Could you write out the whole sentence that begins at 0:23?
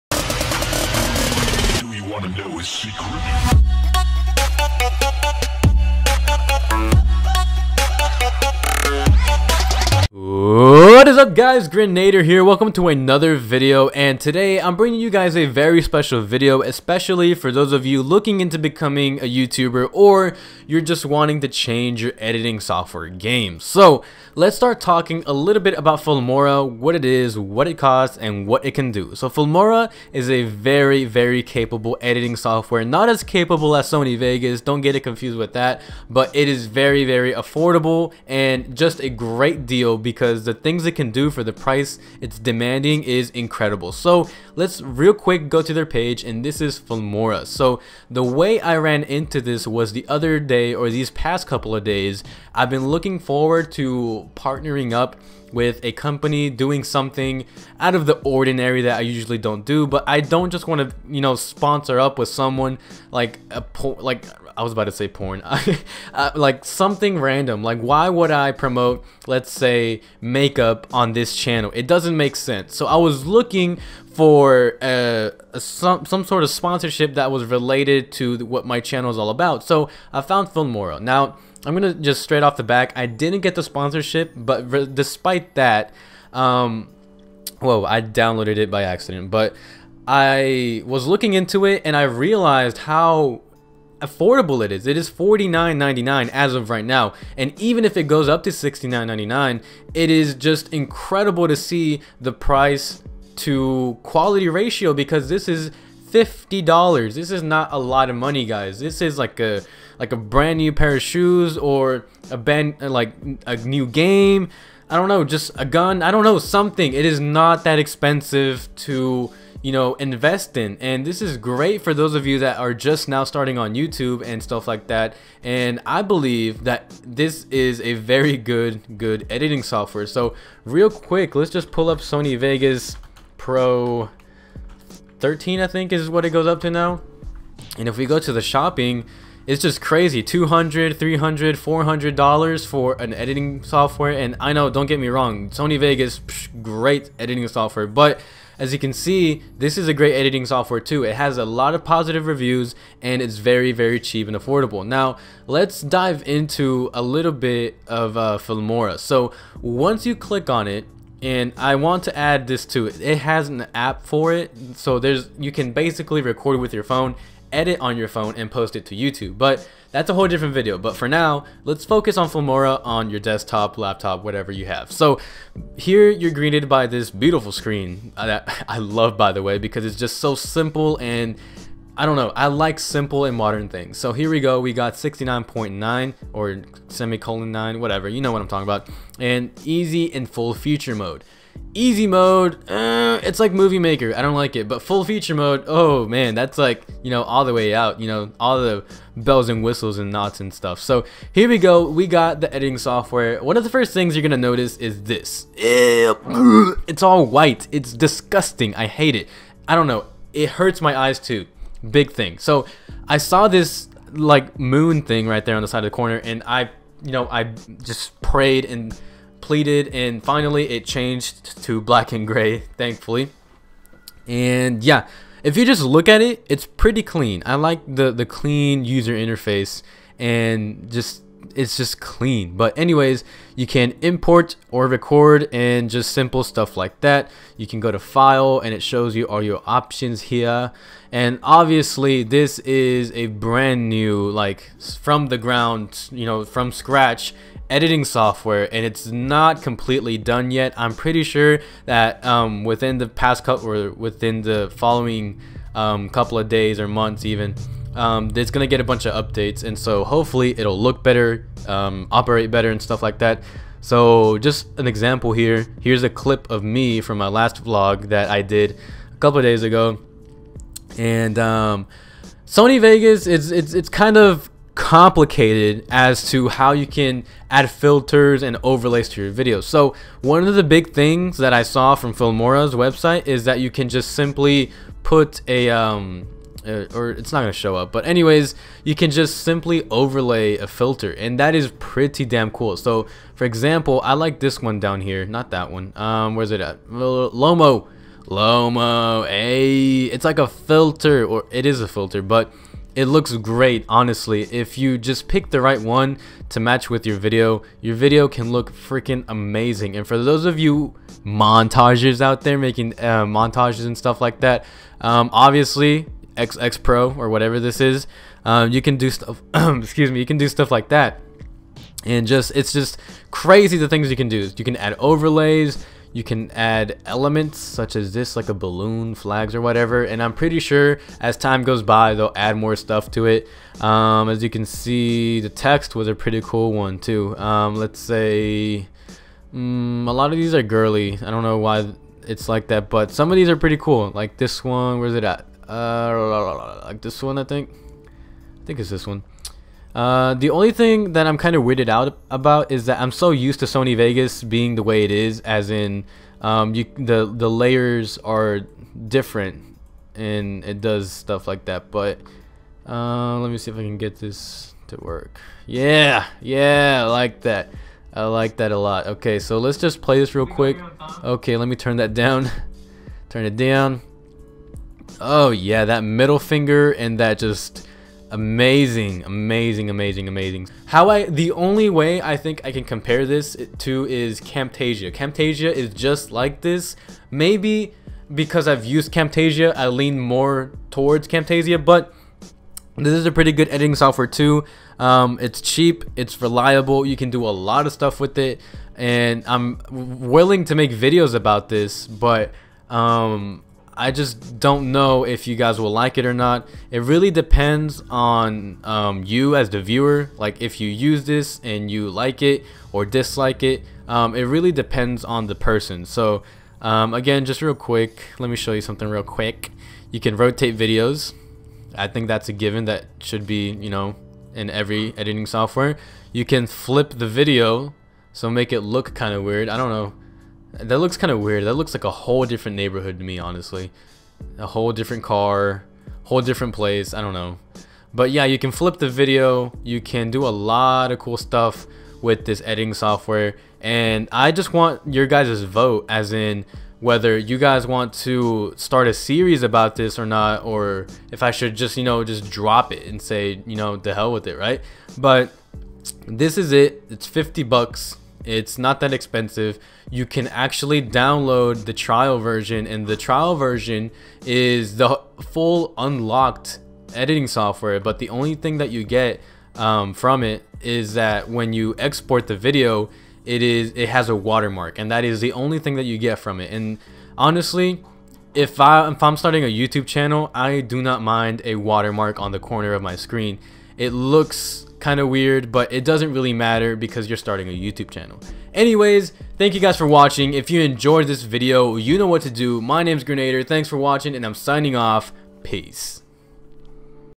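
So let's start talking a little bit about Filmora, what it is, what it costs, and what it can do.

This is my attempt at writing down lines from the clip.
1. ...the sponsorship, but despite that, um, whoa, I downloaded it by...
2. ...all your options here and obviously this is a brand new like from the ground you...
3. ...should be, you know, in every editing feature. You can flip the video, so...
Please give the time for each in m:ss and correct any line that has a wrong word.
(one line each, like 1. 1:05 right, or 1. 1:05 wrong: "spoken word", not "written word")
1. 1:23 right
2. 3:59 right
3. 7:03 wrong: "software", not "feature".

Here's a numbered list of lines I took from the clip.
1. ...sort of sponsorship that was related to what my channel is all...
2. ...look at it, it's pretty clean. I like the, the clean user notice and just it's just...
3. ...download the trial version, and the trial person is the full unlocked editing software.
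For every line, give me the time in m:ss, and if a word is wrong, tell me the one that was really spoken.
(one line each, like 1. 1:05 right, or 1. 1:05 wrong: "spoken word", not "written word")
1. 1:16 right
2. 3:45 wrong: "interface", not "notice"
3. 7:41 wrong: "version", not "person".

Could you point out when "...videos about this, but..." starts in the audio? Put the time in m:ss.
6:40.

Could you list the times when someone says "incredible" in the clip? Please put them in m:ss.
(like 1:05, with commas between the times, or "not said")
0:43, 1:40.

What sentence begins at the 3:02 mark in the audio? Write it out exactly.
I like simple and modern things.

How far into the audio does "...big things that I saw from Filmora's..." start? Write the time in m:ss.
4:40.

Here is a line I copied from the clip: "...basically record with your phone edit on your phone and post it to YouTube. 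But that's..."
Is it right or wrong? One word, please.
right.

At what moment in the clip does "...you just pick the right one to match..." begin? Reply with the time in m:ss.
5:04.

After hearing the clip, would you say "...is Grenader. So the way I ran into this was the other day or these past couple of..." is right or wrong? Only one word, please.
wrong.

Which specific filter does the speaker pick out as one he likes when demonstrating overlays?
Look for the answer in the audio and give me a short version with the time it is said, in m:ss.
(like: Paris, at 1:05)
Lomo A, at 4:58.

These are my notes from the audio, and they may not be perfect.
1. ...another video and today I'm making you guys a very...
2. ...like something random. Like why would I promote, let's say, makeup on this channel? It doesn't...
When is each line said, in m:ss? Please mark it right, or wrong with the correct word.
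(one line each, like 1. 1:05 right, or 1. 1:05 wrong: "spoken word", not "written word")
1. 0:12 wrong: "bringing", not "making"
2. 1:06 right.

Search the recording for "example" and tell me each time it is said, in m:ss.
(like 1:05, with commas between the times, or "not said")
4:24, 4:53.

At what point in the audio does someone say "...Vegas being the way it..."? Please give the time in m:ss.
5:53.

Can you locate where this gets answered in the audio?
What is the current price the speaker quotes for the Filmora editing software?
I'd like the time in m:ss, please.
1:35.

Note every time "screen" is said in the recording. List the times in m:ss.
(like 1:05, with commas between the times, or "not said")
2:57, 8:03.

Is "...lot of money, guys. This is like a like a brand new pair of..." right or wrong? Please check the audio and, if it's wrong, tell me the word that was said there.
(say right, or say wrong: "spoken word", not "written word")
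right.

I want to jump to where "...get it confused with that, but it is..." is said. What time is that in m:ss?
0:34.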